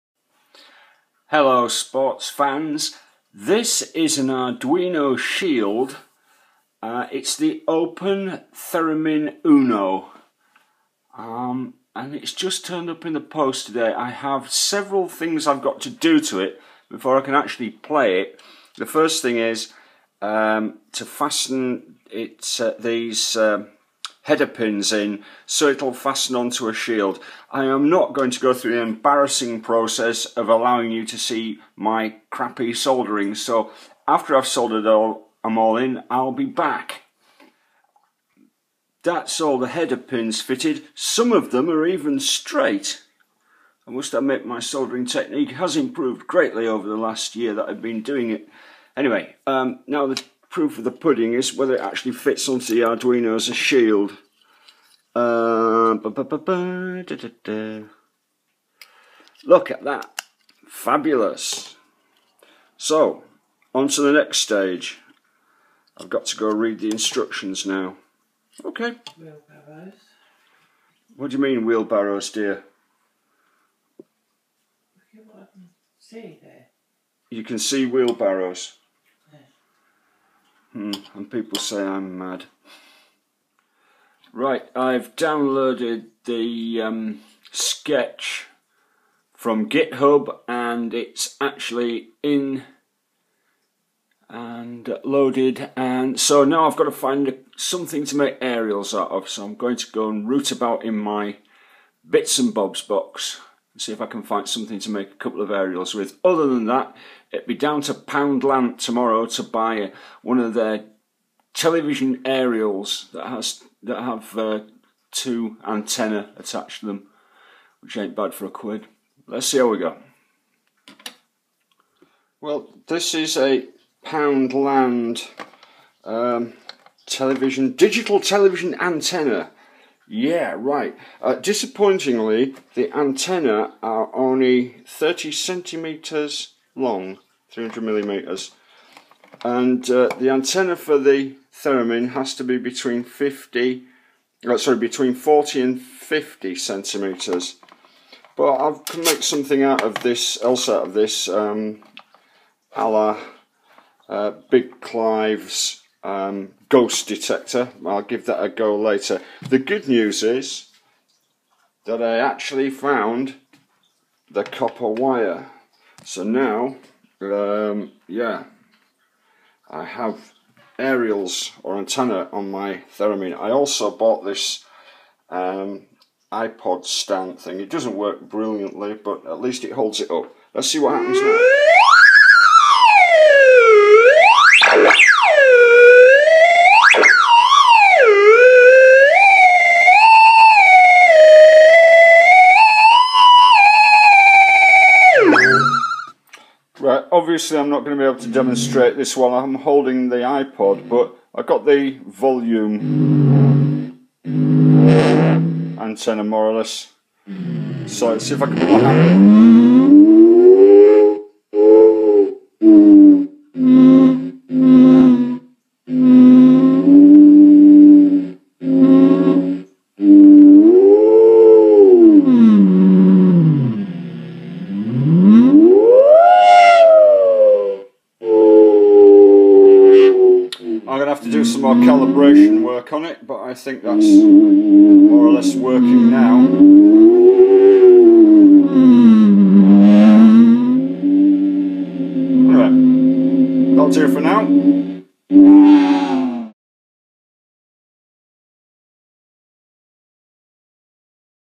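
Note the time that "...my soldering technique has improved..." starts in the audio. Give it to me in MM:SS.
00:44.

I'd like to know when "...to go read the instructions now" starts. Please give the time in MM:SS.
01:06.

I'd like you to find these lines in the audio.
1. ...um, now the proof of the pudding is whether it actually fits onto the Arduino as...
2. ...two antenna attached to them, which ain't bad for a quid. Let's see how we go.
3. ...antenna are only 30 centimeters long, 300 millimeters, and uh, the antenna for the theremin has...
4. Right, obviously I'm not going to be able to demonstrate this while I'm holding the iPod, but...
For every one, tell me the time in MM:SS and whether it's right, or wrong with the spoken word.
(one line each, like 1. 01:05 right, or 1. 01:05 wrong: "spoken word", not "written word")
1. 00:49 right
2. 01:55 right
3. 02:12 right
4. 03:16 right.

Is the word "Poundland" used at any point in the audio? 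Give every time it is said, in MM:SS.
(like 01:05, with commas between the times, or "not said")
01:47, 02:04.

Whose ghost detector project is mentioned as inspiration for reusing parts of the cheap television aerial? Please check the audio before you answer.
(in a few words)
Big Clive.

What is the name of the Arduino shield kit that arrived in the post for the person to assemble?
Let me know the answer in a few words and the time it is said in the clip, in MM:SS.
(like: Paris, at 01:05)
Open Theremin Uno, at 00:07.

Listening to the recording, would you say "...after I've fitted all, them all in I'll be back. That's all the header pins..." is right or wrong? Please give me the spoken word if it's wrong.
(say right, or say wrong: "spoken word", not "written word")
wrong: "soldered", not "fitted".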